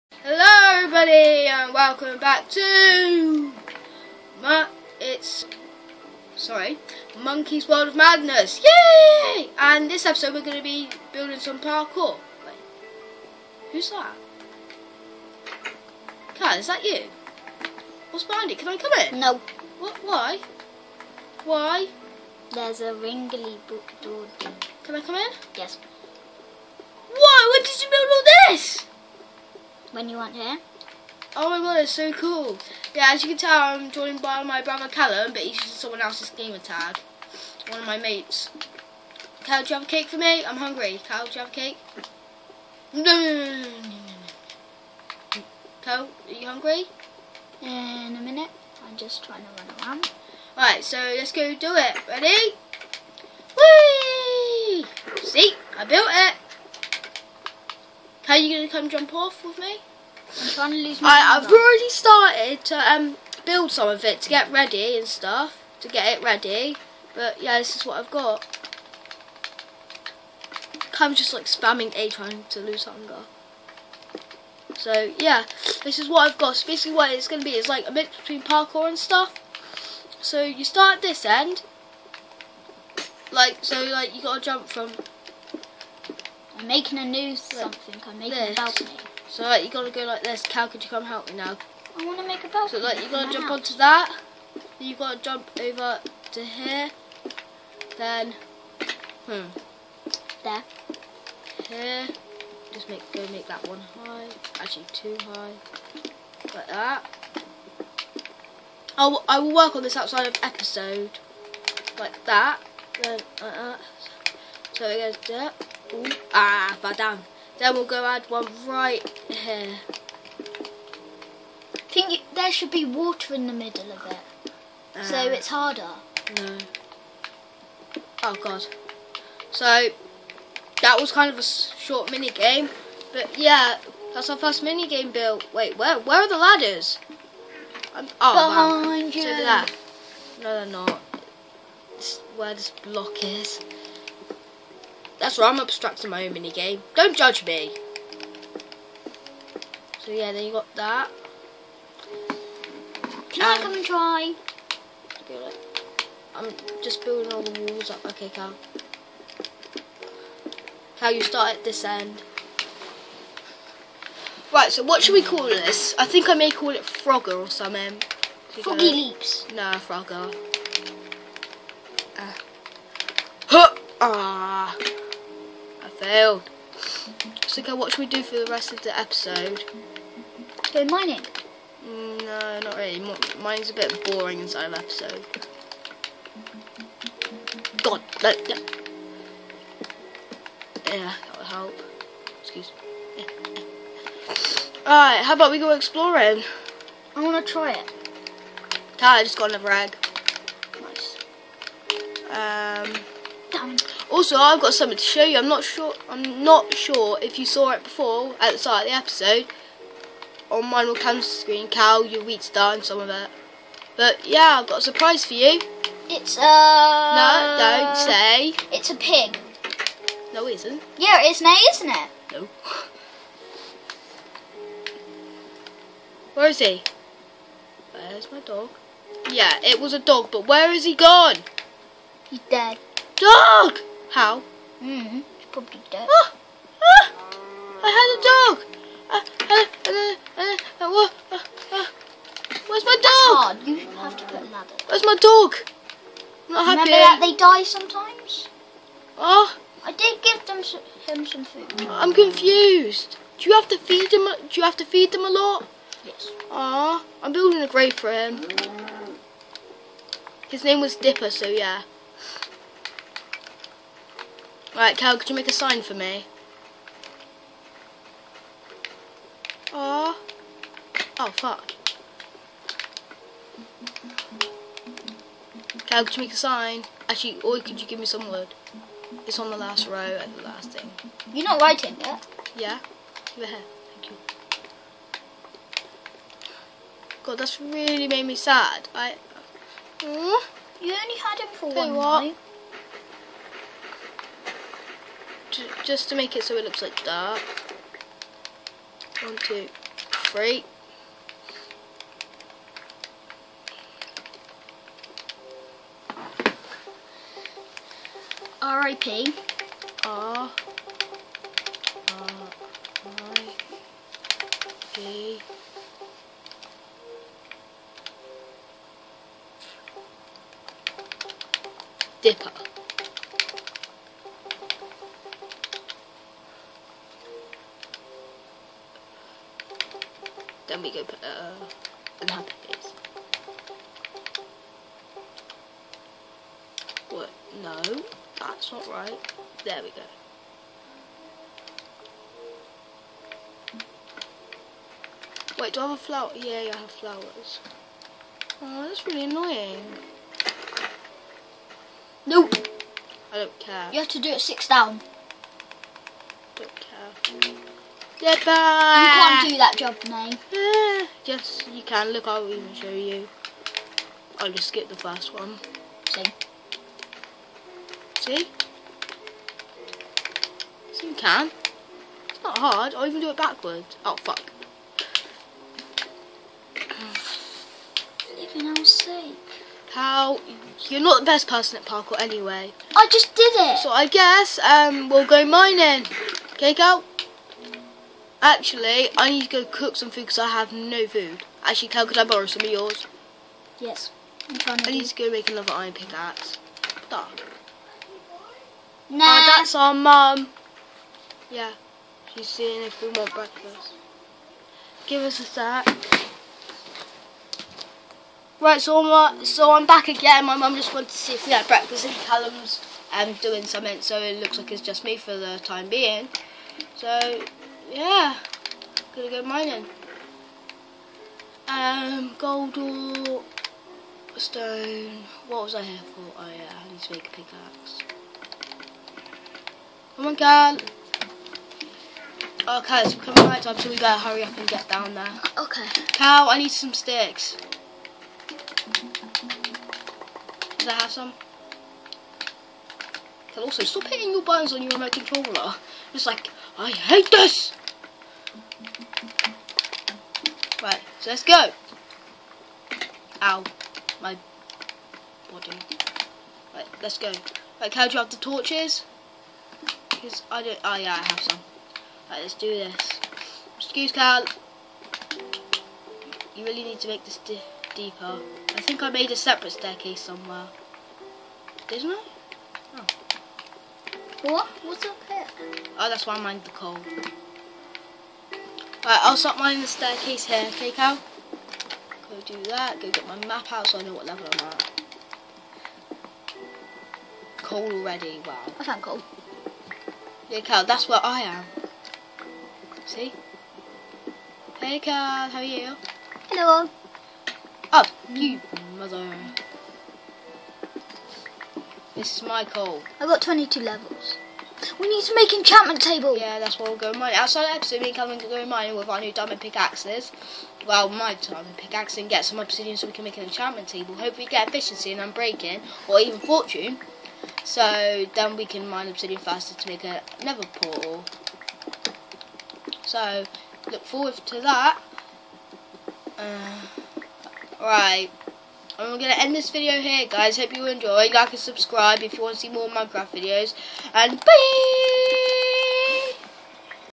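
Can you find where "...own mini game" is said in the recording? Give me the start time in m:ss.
2:26.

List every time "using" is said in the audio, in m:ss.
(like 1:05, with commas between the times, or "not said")
0:35.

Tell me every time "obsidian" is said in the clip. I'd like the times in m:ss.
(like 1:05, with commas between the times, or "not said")
8:32, 8:39.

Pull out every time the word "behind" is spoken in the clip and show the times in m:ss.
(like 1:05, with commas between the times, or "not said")
0:18, 2:18.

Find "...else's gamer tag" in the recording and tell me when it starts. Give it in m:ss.
0:36.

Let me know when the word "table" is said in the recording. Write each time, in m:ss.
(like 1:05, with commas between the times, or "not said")
8:26, 8:33.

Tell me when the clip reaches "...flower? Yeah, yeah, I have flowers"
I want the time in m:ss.
5:45.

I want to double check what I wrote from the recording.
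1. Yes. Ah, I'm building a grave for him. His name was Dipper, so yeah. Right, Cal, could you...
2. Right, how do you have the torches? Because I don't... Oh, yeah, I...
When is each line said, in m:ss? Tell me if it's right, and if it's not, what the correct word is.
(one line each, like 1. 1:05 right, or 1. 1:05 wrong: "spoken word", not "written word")
1. 4:16 right
2. 7:37 right.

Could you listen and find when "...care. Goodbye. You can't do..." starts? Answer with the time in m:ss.
5:56.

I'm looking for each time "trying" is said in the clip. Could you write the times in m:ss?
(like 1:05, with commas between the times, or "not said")
0:49, 1:12, 6:34.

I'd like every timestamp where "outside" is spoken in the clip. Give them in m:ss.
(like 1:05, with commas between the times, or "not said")
1:49, 8:27.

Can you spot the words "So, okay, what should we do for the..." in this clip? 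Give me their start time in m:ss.
2:57.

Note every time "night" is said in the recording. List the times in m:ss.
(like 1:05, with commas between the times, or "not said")
4:52, 7:13.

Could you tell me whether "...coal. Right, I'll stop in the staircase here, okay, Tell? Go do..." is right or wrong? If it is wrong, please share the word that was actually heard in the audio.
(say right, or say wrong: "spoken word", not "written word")
wrong: "Cal", not "Tell".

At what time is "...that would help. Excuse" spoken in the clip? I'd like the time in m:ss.
3:11.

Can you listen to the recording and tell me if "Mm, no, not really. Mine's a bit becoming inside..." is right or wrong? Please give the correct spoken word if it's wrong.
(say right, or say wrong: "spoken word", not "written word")
wrong: "boring", not "becoming".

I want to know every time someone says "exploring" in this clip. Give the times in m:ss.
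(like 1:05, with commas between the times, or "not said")
3:15.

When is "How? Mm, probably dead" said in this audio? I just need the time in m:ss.
3:54.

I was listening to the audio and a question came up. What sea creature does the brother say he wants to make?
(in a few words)
a dolphin.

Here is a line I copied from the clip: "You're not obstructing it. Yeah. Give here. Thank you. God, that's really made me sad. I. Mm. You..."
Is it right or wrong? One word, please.
wrong.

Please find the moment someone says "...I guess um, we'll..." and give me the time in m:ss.
6:23.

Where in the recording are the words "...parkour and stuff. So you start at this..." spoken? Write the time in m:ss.
1:18.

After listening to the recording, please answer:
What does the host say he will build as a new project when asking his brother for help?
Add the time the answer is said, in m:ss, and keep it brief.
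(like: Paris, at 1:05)
a balcony, at 1:28.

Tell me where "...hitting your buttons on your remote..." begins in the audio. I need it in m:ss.
7:24.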